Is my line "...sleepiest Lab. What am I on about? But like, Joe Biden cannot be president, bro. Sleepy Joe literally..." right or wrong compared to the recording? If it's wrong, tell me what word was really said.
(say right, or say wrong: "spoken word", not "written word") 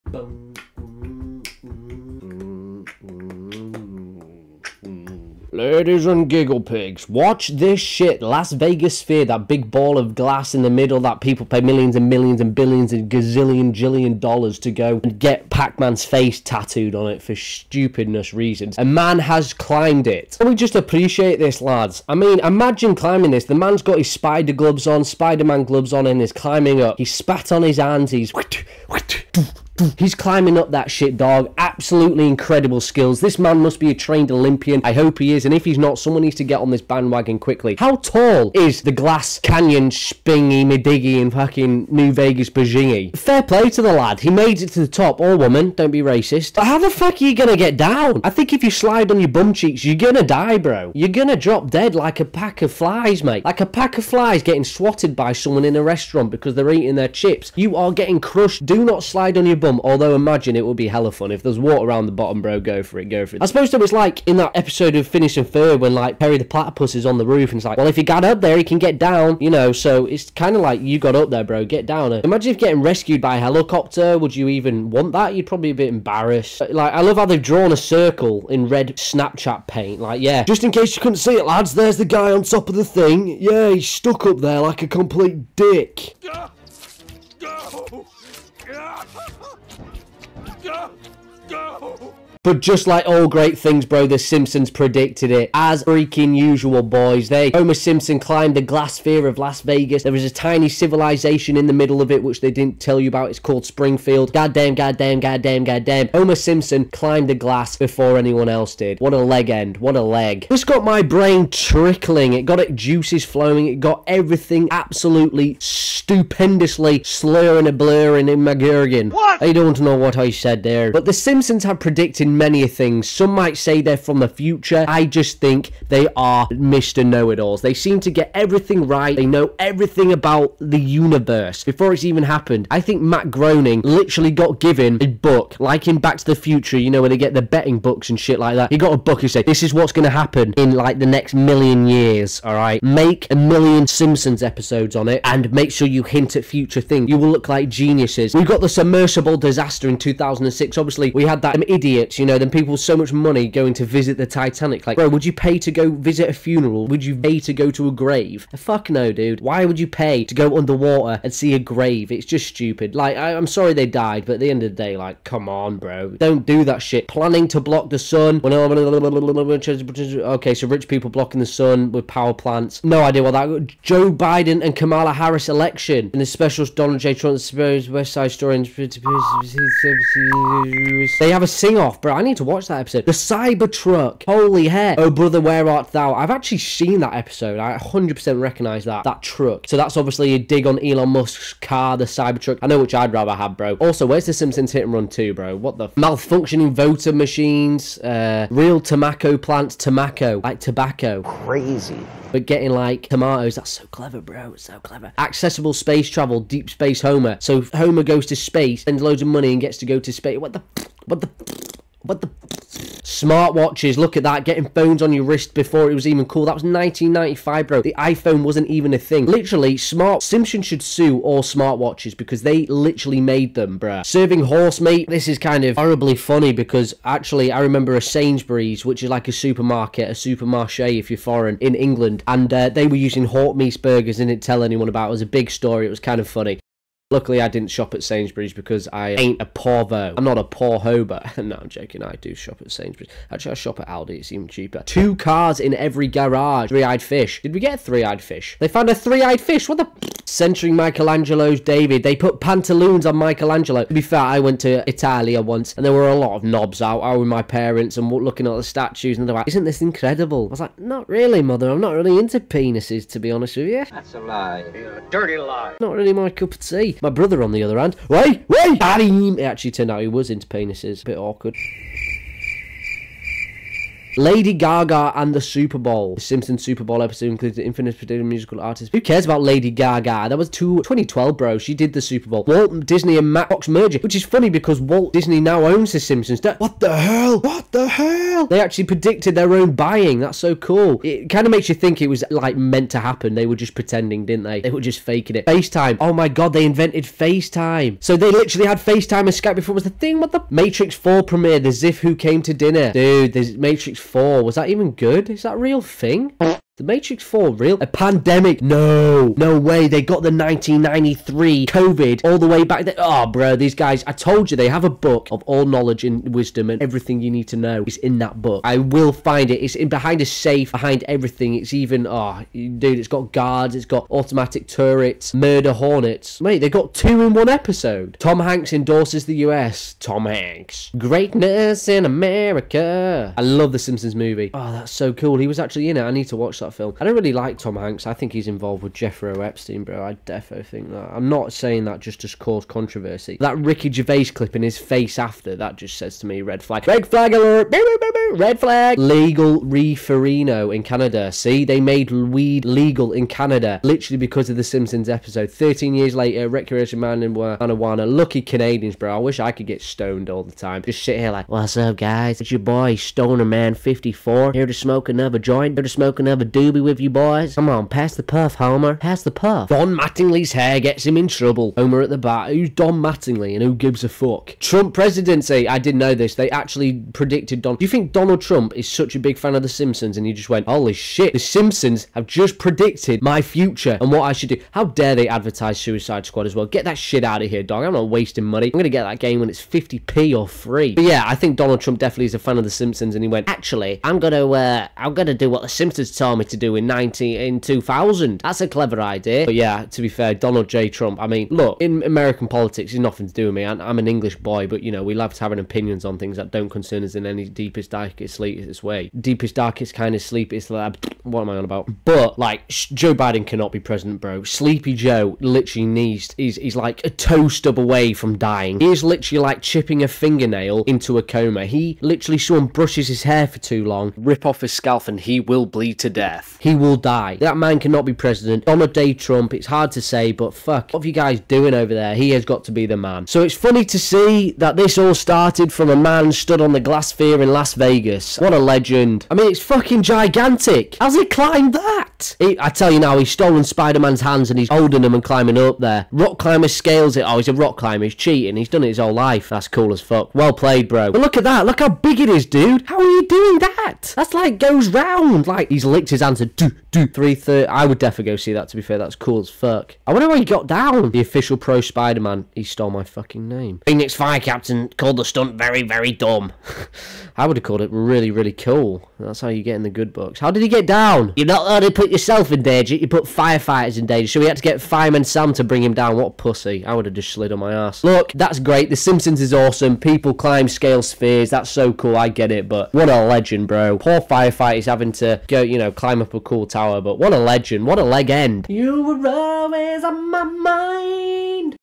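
right.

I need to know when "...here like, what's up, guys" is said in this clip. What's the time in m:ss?
6:01.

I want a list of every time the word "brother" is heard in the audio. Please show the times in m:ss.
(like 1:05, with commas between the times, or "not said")
3:05, 4:27.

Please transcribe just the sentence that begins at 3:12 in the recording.
I know which I'd rather have, bro.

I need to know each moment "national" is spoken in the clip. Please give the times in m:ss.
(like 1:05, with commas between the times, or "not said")
not said.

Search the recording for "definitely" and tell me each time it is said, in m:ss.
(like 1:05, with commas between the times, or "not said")
6:31, 7:37.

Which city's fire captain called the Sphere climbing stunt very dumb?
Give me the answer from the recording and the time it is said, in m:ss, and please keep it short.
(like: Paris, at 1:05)
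Phoenix, at 7:43.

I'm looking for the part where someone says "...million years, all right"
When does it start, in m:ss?
2:21.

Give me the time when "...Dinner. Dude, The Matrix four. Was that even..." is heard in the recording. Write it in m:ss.
5:02.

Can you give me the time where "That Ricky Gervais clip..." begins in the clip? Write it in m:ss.
5:43.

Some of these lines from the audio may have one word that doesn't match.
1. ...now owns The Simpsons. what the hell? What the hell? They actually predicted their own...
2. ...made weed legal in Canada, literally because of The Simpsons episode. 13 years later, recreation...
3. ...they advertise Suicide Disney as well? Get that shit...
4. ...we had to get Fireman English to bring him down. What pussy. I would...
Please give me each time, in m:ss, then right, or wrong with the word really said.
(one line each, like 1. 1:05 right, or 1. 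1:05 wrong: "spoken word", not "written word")
1. 4:45 right
2. 5:51 right
3. 6:25 wrong: "Squad", not "Disney"
4. 7:54 wrong: "Sam", not "English".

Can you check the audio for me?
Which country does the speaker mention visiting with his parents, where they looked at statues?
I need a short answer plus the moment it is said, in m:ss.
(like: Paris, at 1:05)
Italia, at 4:14.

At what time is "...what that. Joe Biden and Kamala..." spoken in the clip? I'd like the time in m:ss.
2:53.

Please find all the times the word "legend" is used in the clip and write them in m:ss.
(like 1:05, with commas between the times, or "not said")
7:18, 8:03, 8:07.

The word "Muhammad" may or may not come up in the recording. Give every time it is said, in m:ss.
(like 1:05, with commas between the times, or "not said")
not said.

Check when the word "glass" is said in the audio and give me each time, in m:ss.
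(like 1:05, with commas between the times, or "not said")
0:10, 0:38, 1:38, 1:47, 7:16.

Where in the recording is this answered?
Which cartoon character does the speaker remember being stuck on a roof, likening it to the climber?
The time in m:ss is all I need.
1:06.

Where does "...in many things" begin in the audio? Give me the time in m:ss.
2:02.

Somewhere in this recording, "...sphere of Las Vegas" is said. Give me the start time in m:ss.
1:38.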